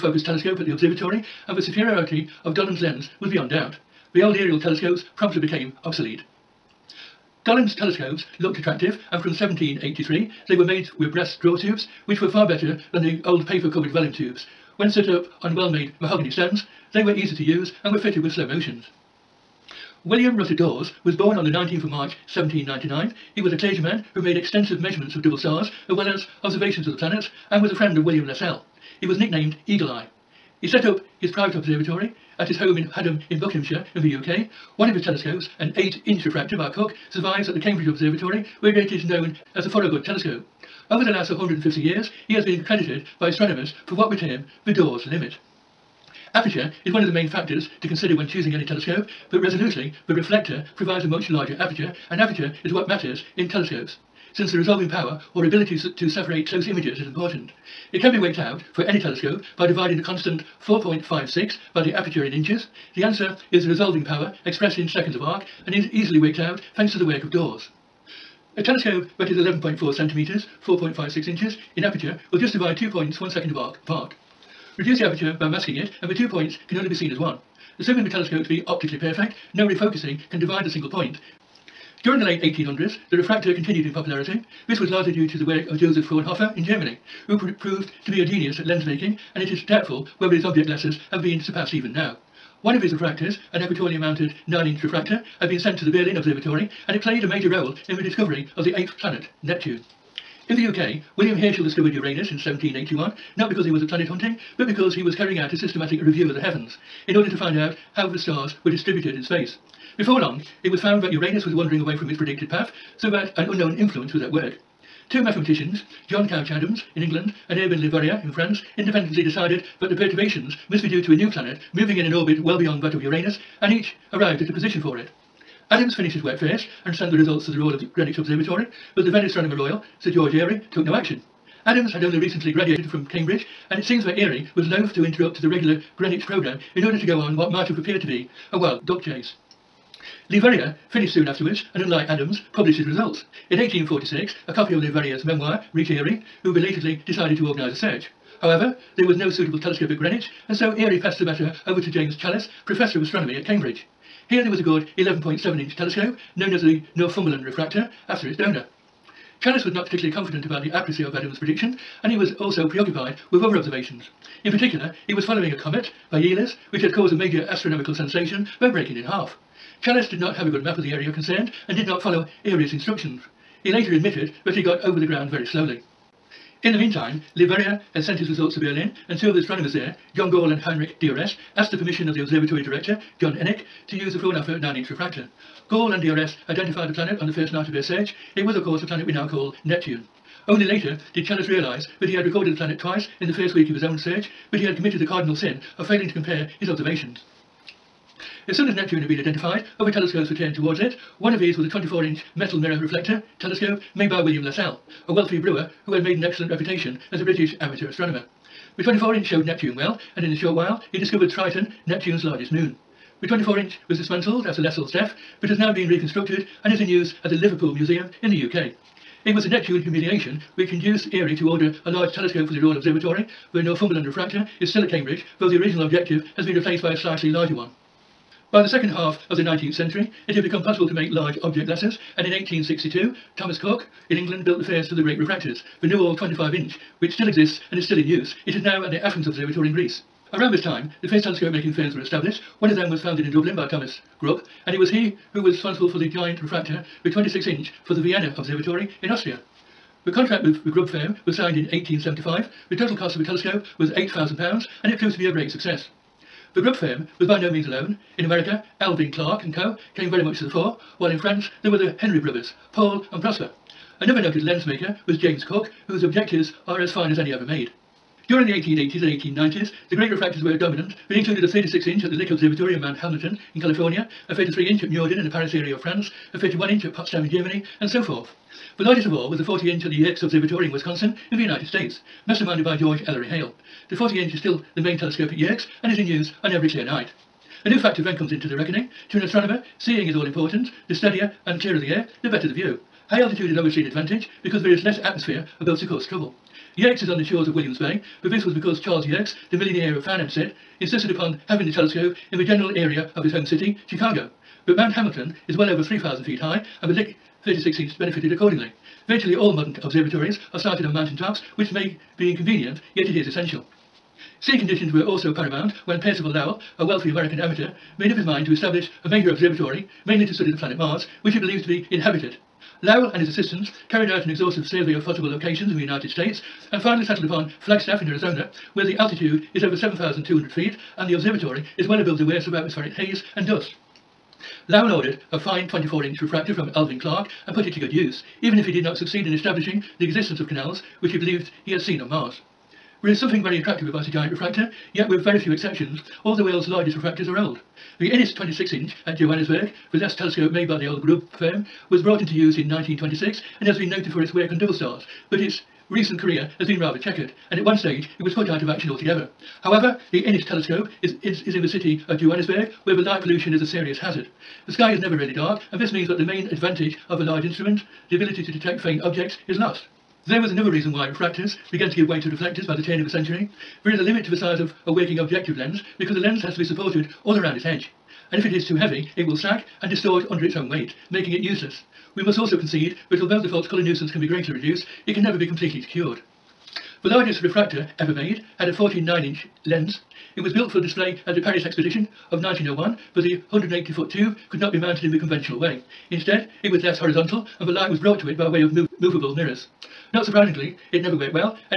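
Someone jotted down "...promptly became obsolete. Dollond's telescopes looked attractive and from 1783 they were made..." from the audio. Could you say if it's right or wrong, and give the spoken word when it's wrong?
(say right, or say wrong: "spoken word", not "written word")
right.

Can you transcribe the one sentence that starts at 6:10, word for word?
There was another reason why refractors began to give way to reflectors by the turn of the century.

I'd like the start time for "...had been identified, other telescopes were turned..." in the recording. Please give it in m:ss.
3:19.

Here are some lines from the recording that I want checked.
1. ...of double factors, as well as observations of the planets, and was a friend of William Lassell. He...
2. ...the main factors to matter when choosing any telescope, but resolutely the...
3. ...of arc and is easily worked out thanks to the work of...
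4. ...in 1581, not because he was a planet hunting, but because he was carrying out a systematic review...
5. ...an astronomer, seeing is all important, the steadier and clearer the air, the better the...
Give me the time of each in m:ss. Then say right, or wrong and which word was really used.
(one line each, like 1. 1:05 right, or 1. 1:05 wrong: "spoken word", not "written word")
1. 0:25 wrong: "stars", not "factors"
2. 0:47 wrong: "consider", not "matter"
3. 1:05 right
4. 1:42 wrong: "1781", not "1581"
5. 4:49 right.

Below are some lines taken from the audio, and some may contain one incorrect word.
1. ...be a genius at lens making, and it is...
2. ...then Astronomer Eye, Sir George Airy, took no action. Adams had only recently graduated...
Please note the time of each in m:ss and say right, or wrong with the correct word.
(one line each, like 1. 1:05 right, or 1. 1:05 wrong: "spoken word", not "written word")
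1. 1:28 right
2. 2:09 wrong: "Royal", not "Eye".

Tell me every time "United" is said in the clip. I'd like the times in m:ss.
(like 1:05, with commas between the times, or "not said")
4:41, 5:25.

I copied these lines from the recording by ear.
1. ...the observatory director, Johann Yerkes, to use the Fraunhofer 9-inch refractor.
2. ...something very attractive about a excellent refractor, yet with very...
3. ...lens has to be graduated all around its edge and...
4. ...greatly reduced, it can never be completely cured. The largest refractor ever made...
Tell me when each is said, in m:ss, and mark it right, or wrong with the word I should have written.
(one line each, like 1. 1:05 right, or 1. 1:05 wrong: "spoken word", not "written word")
1. 3:02 wrong: "Encke", not "Yerkes"
2. 5:43 wrong: "giant", not "excellent"
3. 6:16 wrong: "supported", not "graduated"
4. 6:24 right.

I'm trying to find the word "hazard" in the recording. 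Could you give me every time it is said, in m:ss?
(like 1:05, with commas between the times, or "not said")
6:03.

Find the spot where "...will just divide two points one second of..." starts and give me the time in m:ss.
1:12.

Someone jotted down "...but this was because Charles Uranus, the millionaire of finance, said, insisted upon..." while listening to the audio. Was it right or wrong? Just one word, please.
wrong.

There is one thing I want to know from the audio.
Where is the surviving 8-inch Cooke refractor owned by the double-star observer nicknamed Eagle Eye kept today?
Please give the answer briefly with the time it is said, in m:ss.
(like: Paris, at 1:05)
Cambridge Observatory, at 0:37.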